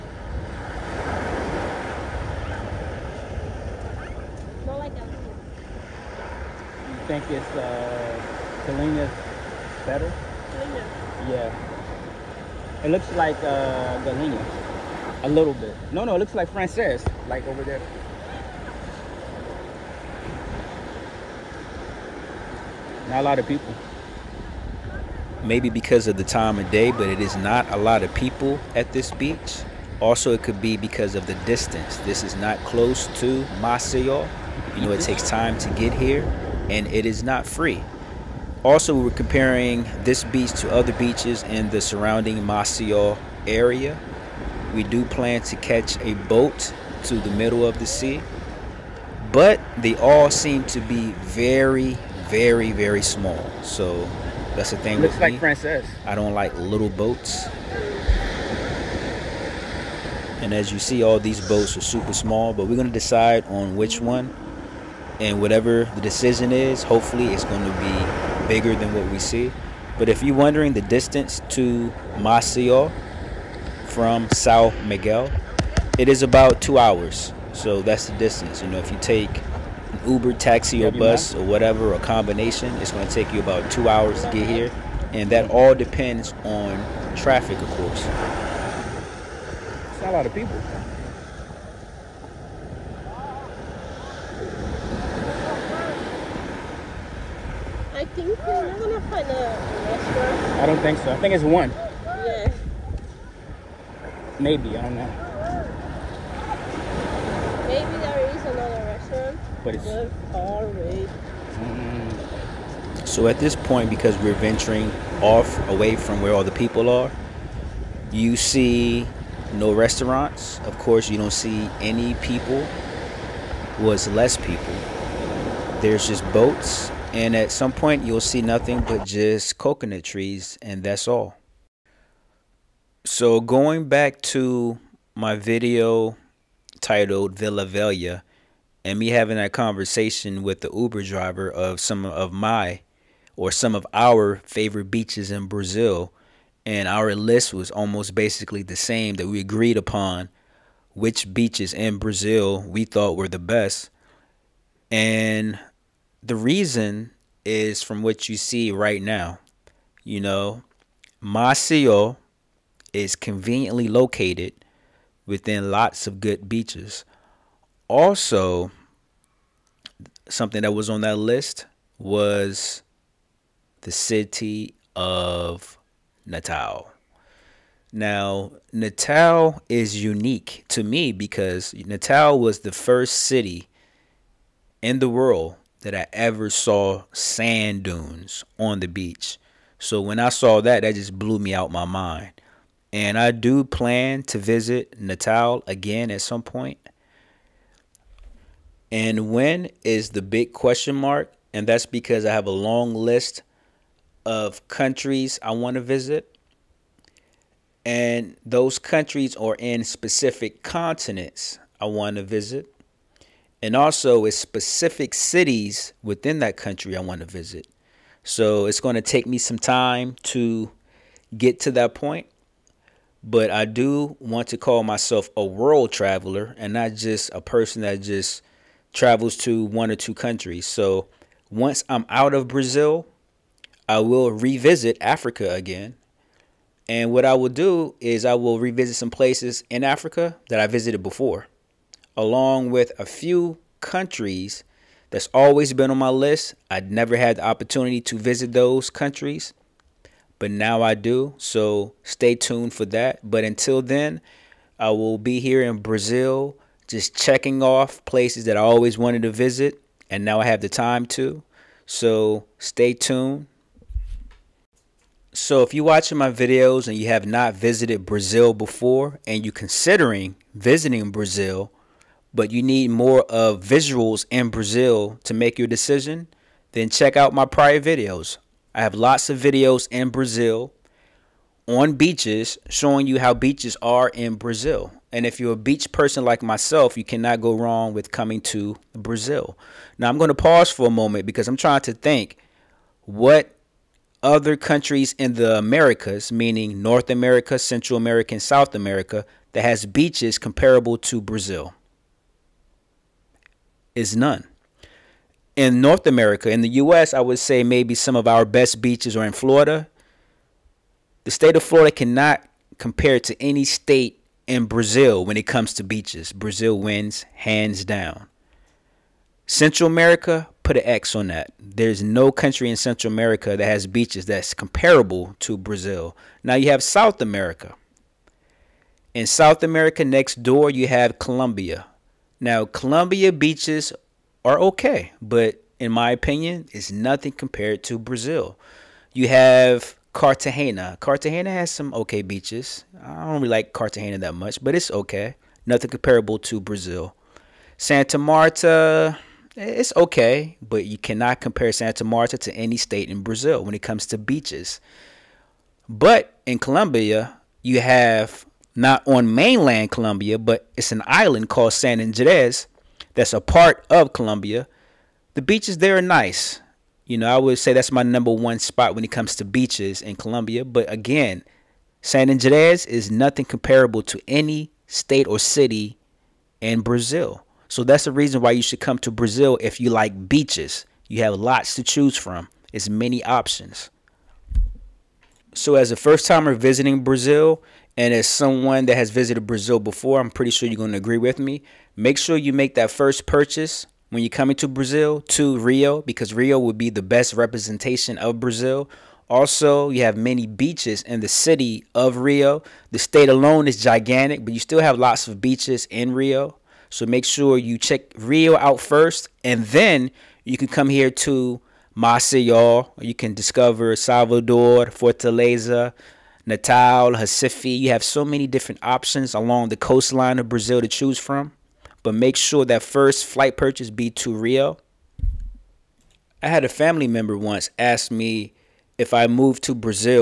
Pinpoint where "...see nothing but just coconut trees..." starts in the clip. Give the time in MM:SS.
02:08.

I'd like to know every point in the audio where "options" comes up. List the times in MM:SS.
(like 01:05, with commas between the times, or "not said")
06:23, 06:58.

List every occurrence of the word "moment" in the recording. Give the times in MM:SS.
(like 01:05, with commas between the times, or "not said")
04:50.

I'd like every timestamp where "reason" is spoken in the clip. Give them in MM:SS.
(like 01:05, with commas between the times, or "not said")
02:36, 06:18.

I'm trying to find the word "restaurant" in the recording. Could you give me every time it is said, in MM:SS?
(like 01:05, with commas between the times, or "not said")
01:39, 01:48, 01:59.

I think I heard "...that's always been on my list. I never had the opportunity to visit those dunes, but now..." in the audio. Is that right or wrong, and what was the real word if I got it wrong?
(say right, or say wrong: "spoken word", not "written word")
wrong: "countries", not "dunes".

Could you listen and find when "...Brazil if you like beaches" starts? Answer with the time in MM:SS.
06:19.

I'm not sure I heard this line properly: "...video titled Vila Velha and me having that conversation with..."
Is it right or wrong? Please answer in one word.
right.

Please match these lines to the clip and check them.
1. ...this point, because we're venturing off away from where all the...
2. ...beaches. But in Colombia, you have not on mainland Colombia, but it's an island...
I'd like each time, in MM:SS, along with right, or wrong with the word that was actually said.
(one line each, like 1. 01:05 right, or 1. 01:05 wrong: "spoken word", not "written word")
1. 01:53 right
2. 05:54 right.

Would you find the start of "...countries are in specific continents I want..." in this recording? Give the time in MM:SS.
03:28.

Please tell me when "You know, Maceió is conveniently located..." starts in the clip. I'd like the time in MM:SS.
02:40.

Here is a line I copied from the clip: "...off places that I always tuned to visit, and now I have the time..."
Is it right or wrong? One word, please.
wrong.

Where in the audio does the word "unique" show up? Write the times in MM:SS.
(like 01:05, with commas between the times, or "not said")
03:00.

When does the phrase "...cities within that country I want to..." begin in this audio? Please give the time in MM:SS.
03:35.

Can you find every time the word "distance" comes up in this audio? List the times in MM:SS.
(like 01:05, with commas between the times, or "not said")
00:31, 01:10, 01:18.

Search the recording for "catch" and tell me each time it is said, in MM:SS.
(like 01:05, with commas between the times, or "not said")
00:45.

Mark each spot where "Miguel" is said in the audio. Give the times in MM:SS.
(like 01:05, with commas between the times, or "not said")
01:14.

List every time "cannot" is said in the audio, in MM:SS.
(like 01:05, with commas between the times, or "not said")
04:47, 05:11, 05:50.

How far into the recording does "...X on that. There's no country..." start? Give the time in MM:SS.
05:20.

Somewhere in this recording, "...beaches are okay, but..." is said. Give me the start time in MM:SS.
05:33.